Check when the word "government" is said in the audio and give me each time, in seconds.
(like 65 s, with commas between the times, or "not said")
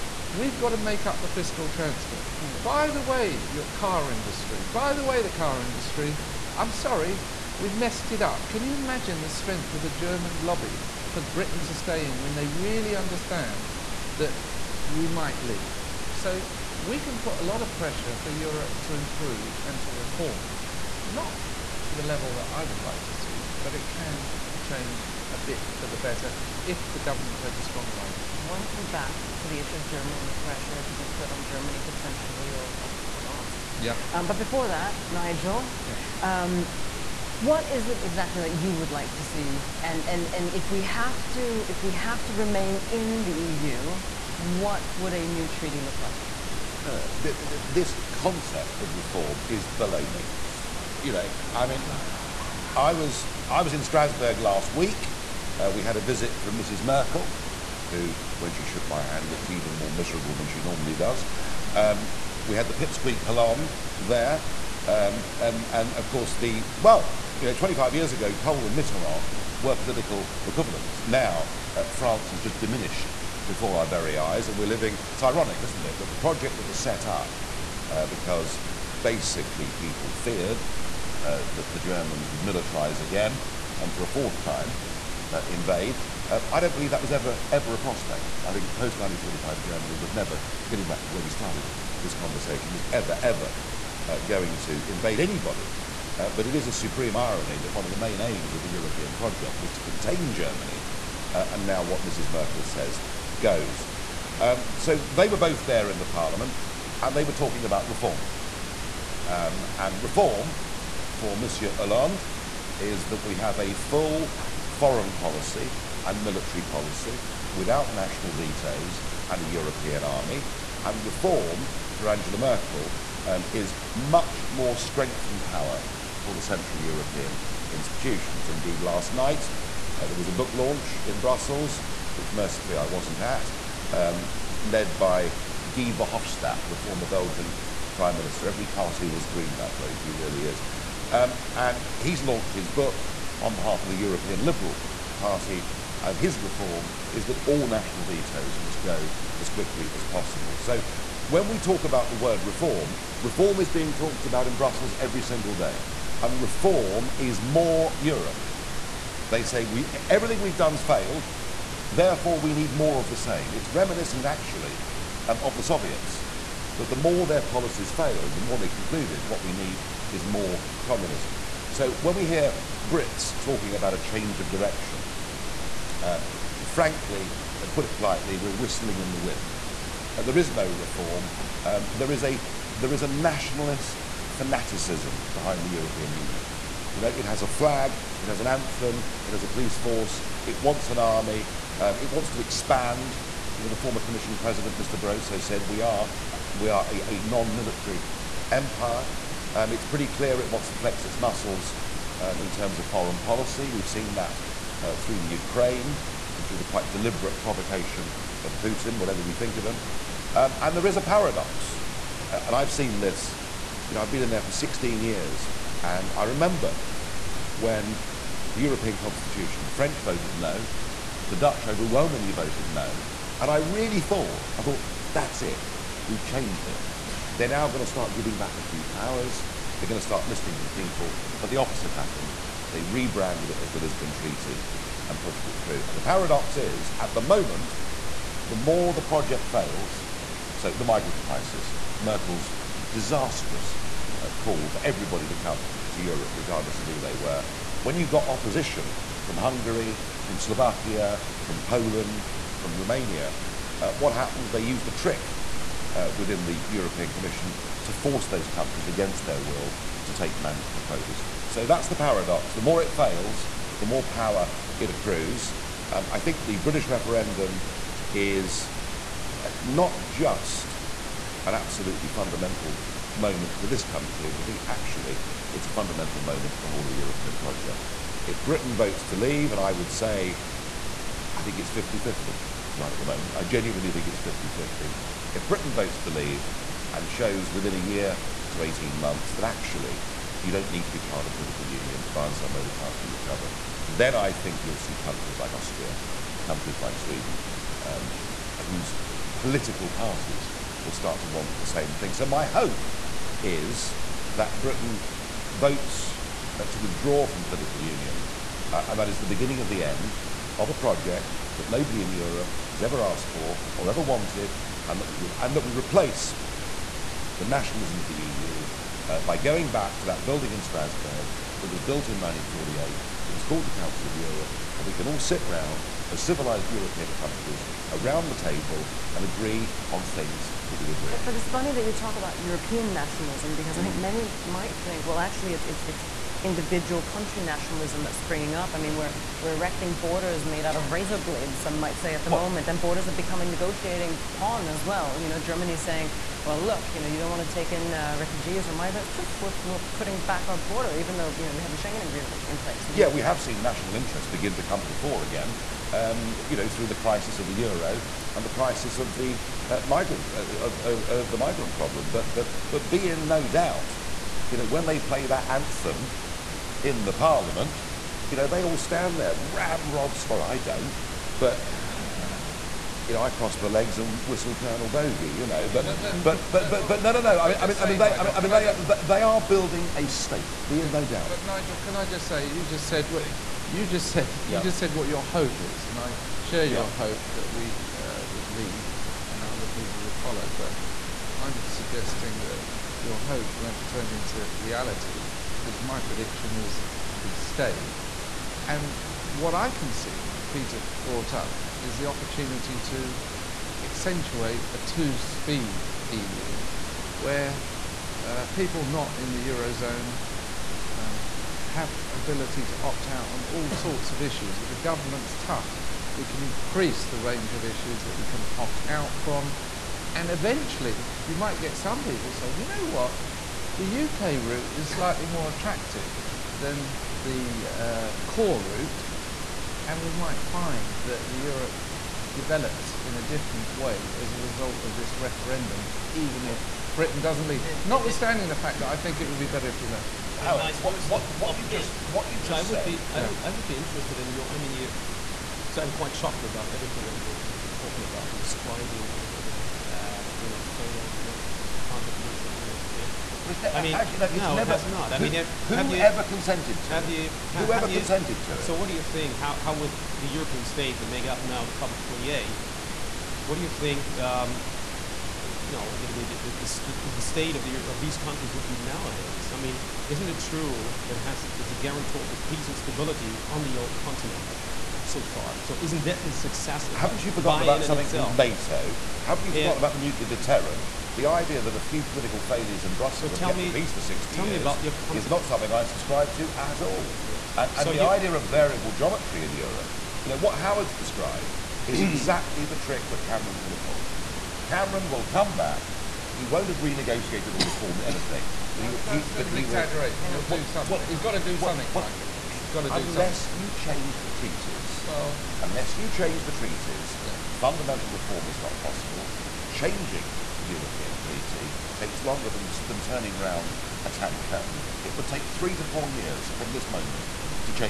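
26 s, 414 s.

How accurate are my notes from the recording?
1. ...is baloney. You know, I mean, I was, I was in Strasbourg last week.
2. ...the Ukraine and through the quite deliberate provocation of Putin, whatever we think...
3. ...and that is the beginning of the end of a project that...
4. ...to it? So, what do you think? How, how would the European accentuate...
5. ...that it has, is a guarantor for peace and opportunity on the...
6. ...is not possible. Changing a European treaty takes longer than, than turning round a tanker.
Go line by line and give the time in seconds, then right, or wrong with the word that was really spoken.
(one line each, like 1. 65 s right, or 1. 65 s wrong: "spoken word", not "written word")
1. 49 s right
2. 205 s right
3. 308 s right
4. 458 s wrong: "state", not "accentuate"
5. 471 s wrong: "stability", not "opportunity"
6. 508 s right.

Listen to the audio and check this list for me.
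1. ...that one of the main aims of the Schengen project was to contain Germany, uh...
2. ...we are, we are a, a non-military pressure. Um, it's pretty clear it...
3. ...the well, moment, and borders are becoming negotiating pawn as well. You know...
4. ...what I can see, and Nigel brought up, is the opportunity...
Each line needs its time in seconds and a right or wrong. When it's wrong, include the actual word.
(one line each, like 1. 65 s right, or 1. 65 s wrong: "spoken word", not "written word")
1. 97 s wrong: "European", not "Schengen"
2. 195 s wrong: "empire", not "pressure"
3. 342 s right
4. 399 s wrong: "Peter", not "Nigel".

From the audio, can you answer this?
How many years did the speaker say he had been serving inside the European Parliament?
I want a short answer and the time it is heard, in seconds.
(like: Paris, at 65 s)
16, at 214 s.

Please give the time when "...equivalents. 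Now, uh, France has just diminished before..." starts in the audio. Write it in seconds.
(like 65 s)
70 s.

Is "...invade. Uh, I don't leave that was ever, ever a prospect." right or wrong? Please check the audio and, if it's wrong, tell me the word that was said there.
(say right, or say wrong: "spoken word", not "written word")
wrong: "believe", not "leave".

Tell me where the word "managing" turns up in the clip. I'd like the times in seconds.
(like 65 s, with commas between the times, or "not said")
not said.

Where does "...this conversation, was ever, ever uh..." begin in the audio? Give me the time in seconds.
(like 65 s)
92 s.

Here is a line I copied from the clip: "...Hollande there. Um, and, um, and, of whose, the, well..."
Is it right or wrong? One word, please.
wrong.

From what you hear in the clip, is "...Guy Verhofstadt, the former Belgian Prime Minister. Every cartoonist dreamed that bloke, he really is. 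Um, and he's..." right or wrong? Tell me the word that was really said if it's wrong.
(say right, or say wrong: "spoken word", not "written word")
right.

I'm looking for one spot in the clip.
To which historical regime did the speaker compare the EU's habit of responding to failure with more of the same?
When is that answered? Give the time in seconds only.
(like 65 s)
165 s.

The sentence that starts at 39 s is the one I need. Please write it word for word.
And, and, and if, we have to, if we have to remain in the EU, what would a new treaty look like?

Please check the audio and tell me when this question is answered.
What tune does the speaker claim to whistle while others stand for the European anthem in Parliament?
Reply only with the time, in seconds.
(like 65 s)
374 s.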